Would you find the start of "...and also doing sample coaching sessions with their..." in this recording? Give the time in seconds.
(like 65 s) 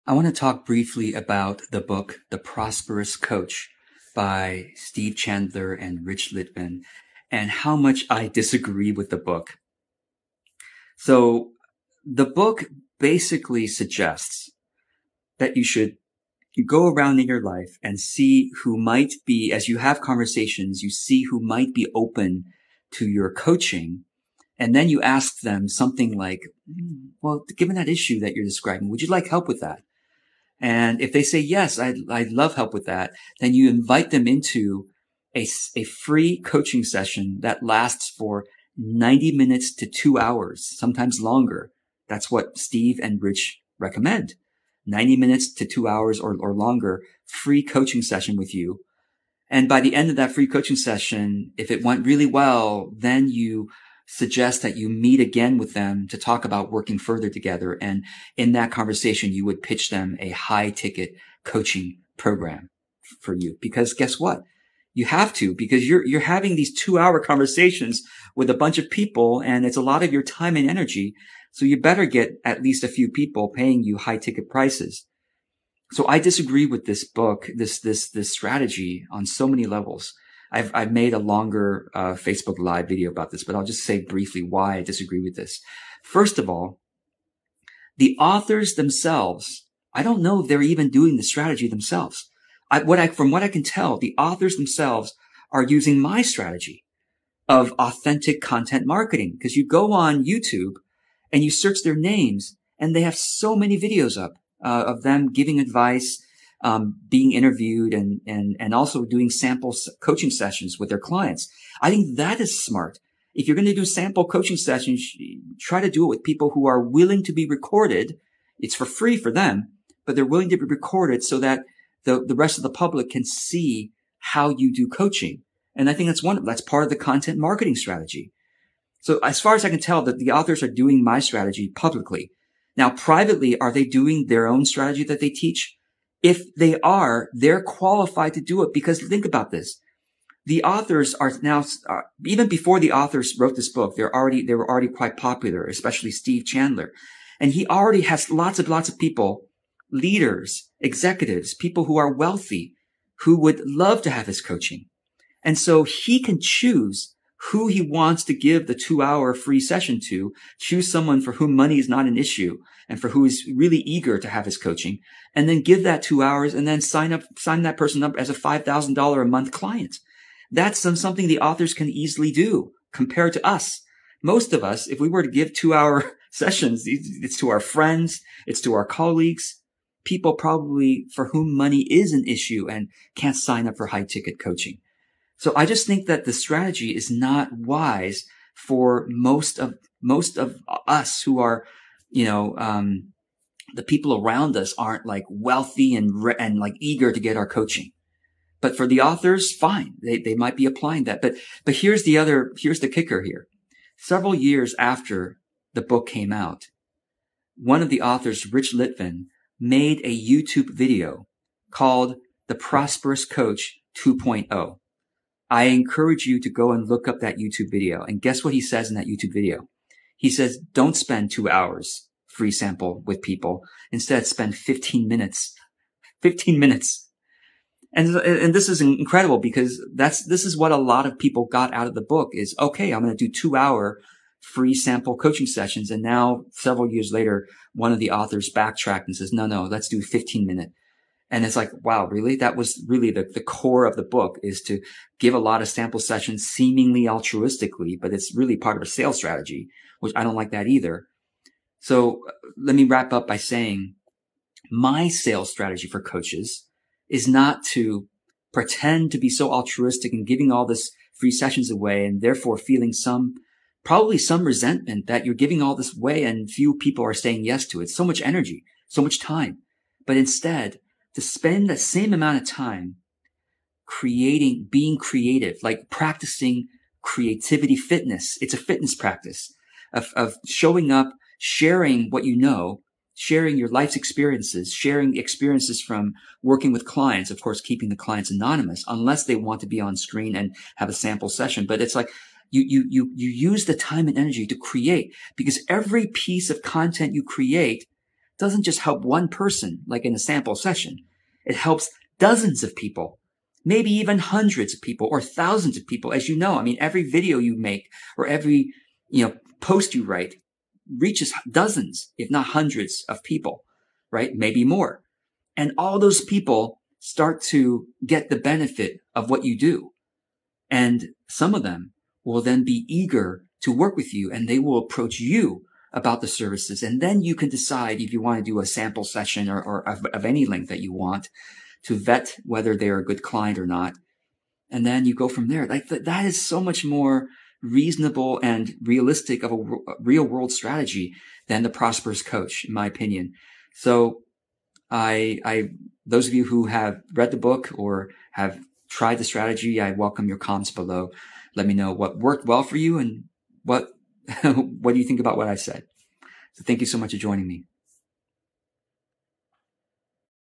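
108 s.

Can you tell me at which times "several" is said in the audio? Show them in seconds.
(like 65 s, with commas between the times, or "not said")
203 s, 236 s.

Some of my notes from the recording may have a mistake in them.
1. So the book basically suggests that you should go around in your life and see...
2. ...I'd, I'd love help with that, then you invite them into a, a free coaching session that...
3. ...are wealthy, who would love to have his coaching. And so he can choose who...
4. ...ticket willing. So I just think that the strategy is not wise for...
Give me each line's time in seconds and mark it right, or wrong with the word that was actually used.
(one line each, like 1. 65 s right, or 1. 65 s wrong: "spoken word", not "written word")
1. 10 s right
2. 31 s right
3. 151 s right
4. 184 s wrong: "coaching", not "willing".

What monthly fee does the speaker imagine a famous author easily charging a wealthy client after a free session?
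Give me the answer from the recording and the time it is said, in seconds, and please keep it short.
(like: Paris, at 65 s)
$5,000 a month, at 168 s.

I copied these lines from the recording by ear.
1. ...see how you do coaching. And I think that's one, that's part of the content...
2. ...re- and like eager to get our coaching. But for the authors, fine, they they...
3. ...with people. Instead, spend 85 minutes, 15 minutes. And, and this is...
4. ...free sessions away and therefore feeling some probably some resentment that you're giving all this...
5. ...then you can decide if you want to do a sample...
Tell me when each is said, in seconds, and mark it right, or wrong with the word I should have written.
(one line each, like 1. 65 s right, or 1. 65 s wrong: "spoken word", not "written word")
1. 123 s right
2. 196 s right
3. 223 s wrong: "15", not "85"
4. 261 s right
5. 327 s right.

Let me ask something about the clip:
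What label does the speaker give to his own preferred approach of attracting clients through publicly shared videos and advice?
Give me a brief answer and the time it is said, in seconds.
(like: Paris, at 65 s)
authentic content marketing, at 97 s.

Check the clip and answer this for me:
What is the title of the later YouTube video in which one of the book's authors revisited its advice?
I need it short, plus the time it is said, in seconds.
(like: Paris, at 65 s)
The Prosperous Coach 2.0, at 212 s.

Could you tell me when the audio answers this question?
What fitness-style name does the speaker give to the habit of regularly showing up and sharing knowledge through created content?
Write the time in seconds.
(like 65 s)
277 s.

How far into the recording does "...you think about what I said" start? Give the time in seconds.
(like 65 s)
354 s.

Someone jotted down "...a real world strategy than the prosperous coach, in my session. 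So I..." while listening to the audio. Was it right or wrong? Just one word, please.
wrong.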